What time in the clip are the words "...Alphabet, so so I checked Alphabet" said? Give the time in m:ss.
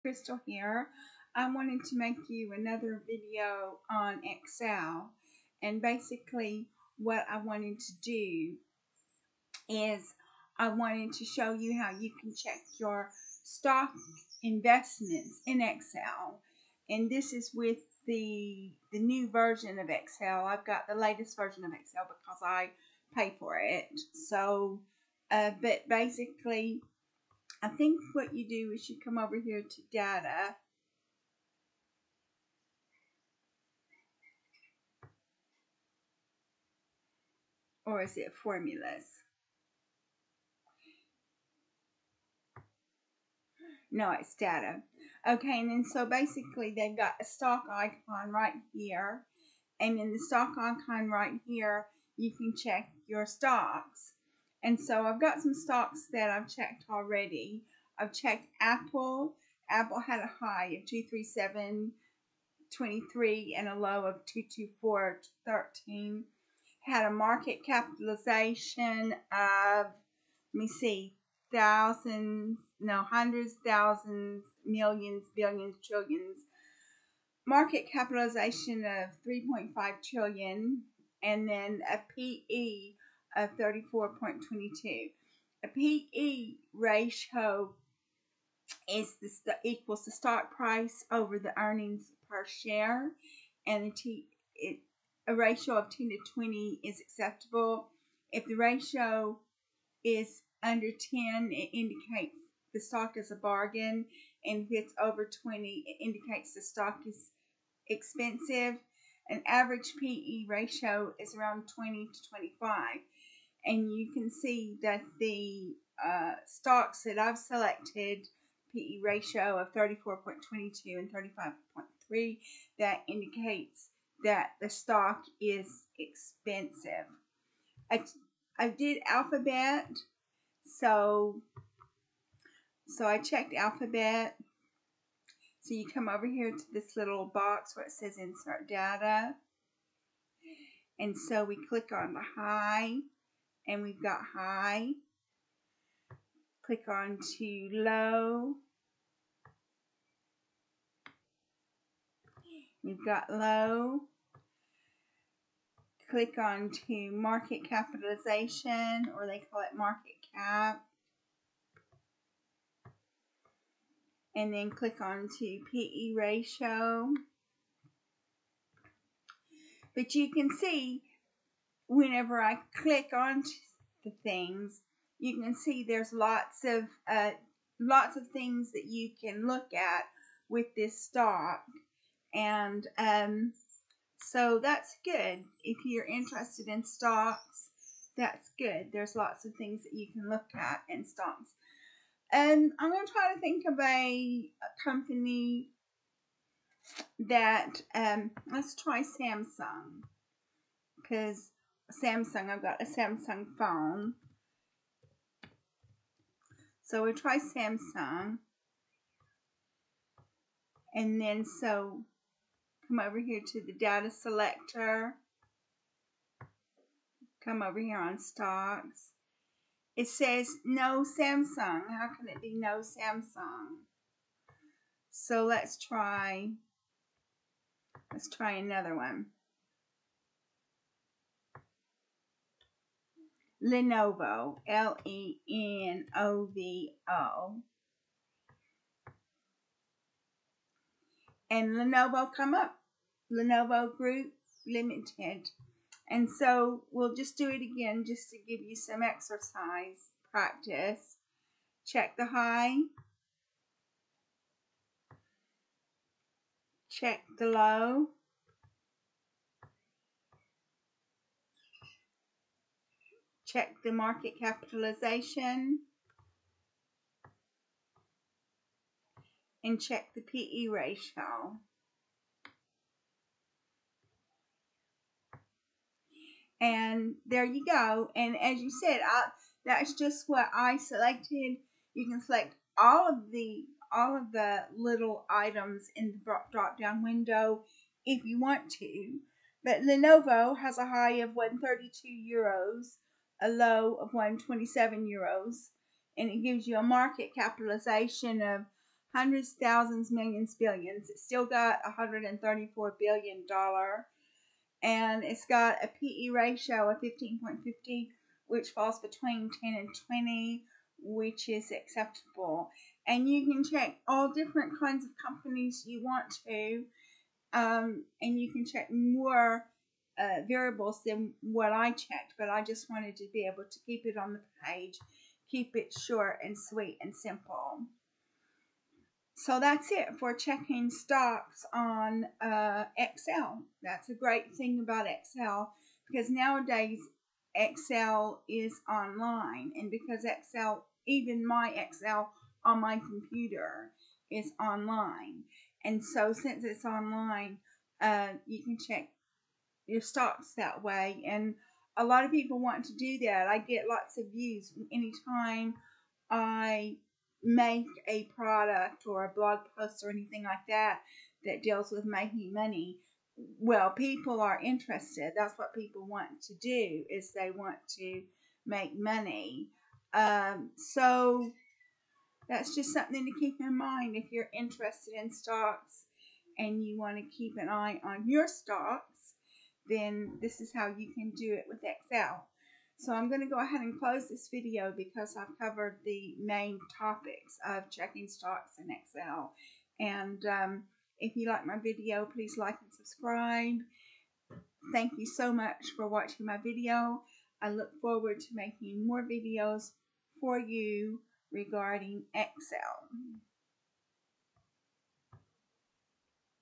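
2:09.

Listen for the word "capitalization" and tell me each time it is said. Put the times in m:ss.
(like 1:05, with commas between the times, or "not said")
1:07, 1:17, 2:37, 4:24, 4:57.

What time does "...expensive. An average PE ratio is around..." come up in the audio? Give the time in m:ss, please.
1:47.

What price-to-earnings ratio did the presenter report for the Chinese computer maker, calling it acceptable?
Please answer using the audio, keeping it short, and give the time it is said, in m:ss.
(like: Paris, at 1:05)
15.50, at 5:07.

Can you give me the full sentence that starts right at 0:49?
And in the stock icon right here, you can check your stocks.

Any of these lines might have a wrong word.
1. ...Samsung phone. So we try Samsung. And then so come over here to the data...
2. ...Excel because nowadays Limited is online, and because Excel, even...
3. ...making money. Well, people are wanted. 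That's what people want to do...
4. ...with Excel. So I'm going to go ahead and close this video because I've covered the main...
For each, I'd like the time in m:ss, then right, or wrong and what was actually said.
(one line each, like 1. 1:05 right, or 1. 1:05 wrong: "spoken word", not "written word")
1. 3:22 right
2. 5:35 wrong: "Excel", not "Limited"
3. 6:02 wrong: "interested", not "wanted"
4. 6:21 right.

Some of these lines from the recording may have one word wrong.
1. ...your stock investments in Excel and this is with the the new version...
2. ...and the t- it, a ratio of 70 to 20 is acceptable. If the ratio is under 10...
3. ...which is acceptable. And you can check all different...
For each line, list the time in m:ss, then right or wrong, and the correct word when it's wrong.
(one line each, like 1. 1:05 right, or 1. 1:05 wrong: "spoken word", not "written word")
1. 0:12 right
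2. 1:33 wrong: "10", not "70"
3. 5:11 right.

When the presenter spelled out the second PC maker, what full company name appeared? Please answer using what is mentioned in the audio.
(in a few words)
Lenovo Group Limited.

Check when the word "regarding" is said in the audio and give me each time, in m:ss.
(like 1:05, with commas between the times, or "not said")
6:41.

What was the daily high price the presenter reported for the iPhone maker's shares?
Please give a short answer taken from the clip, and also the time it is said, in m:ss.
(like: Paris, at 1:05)
237.23, at 1:01.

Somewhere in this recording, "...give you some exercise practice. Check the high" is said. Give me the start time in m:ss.
4:08.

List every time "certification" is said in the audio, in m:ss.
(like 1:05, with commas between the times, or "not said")
not said.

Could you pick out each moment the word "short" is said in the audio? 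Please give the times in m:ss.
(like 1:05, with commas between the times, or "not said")
5:25.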